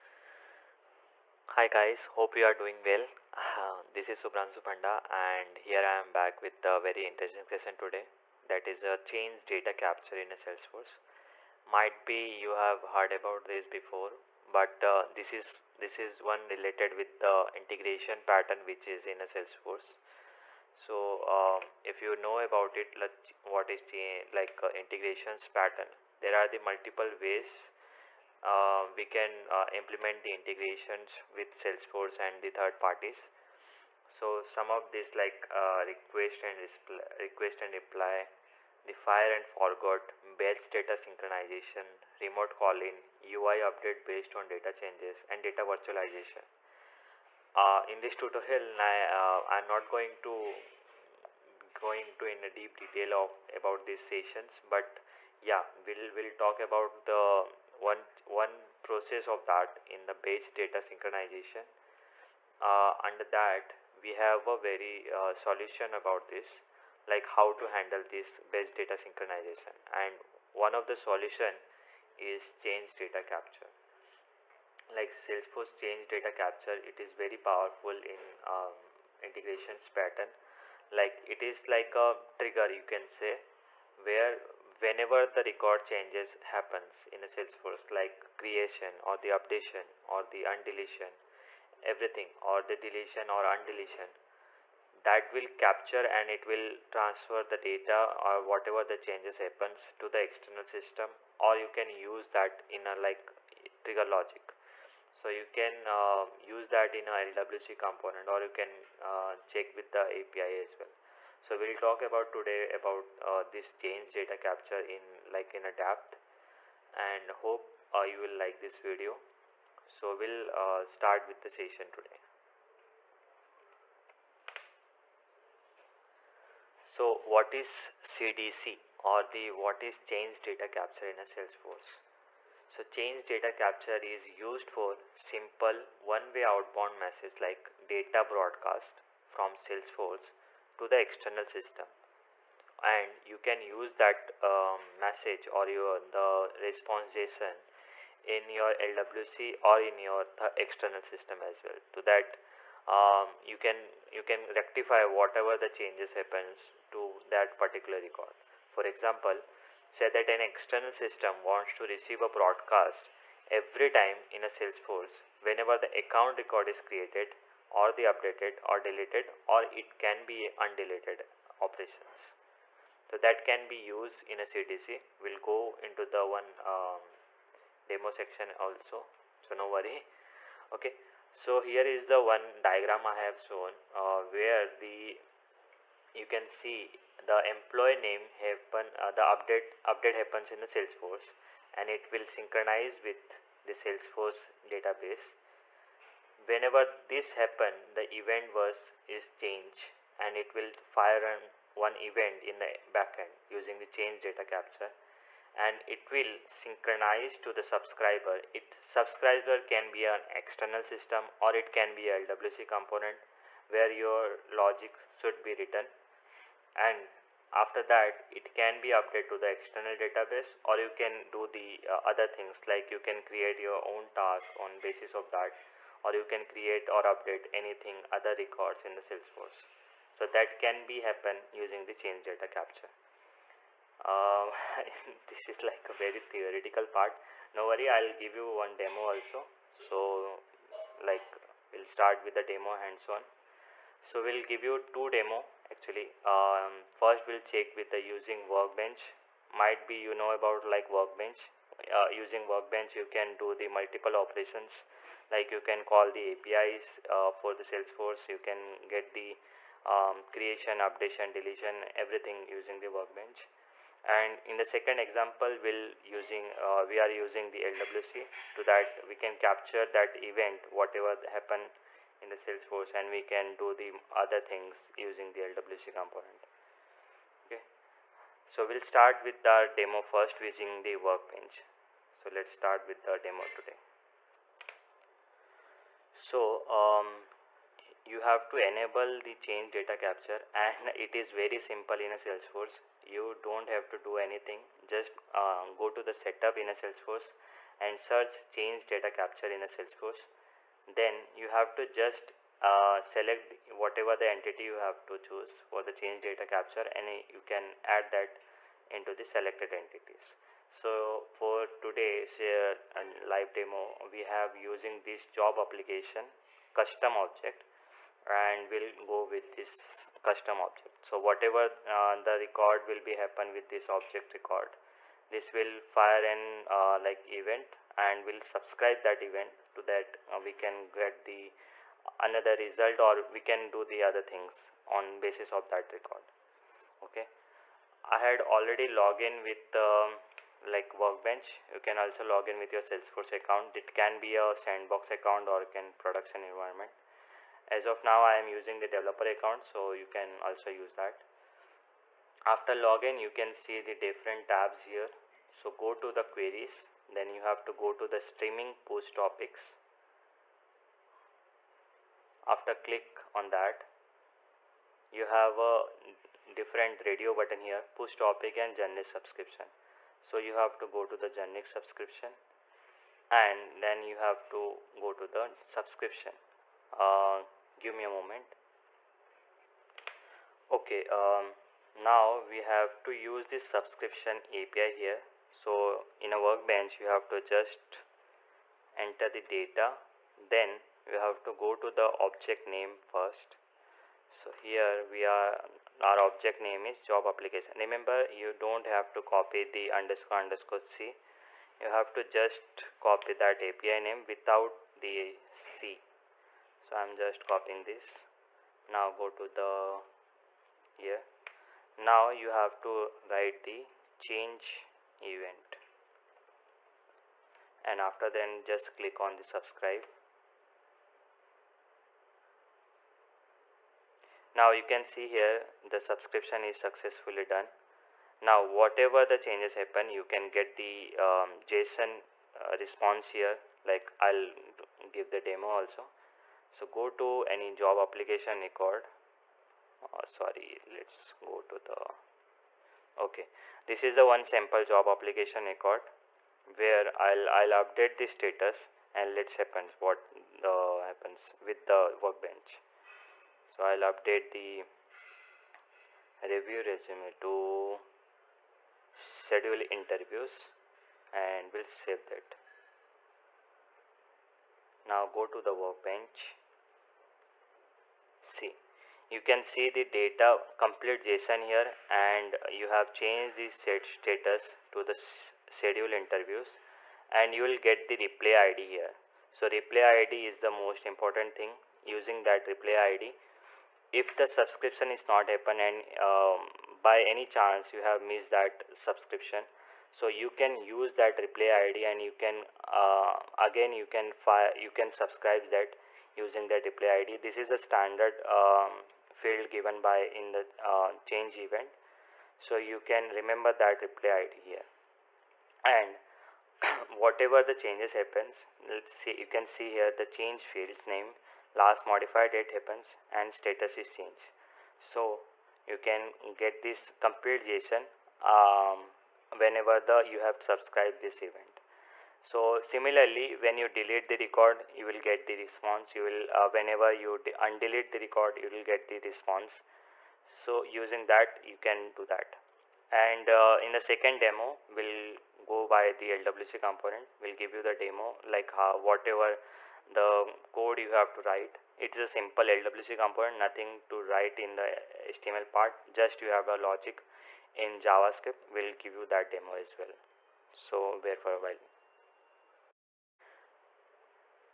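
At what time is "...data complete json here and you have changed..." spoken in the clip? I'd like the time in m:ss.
7:50.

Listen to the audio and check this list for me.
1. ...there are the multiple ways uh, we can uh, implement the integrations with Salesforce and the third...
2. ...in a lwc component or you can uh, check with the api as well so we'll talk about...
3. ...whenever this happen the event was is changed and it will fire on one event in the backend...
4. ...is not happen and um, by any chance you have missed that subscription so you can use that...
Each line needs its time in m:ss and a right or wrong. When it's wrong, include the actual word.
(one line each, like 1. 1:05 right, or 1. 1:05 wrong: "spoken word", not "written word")
1. 0:26 right
2. 1:46 right
3. 3:16 right
4. 8:05 right.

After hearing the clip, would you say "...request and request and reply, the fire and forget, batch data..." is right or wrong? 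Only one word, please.
right.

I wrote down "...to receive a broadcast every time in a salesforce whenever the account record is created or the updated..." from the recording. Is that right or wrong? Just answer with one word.
right.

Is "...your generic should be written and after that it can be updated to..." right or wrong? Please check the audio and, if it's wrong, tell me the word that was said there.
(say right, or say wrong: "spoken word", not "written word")
wrong: "logic", not "generic".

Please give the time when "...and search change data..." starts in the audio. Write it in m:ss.
4:57.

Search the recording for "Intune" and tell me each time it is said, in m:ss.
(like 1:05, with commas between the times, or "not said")
not said.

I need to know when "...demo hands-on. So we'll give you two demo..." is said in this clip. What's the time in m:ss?
4:02.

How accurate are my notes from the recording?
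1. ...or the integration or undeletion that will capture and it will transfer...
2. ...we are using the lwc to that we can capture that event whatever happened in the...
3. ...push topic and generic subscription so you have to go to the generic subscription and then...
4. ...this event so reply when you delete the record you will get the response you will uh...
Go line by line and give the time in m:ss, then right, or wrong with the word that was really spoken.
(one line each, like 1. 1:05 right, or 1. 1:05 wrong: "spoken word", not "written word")
1. 1:32 wrong: "deletion", not "integration"
2. 4:26 right
3. 6:07 right
4. 8:41 wrong: "similarly", not "reply".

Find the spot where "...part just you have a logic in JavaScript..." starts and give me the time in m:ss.
9:05.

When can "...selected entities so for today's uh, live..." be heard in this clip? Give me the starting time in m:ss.
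5:09.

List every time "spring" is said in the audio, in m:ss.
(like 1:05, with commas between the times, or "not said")
not said.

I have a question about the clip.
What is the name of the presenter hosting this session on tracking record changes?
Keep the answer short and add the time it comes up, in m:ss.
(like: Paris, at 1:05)
Shubhranshu Panda, at 0:04.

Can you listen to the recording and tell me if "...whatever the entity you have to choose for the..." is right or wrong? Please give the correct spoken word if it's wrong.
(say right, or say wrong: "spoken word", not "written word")
right.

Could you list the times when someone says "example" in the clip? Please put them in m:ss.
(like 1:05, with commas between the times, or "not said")
2:38, 4:25.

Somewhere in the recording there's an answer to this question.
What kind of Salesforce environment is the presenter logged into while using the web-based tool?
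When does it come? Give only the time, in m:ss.
5:48.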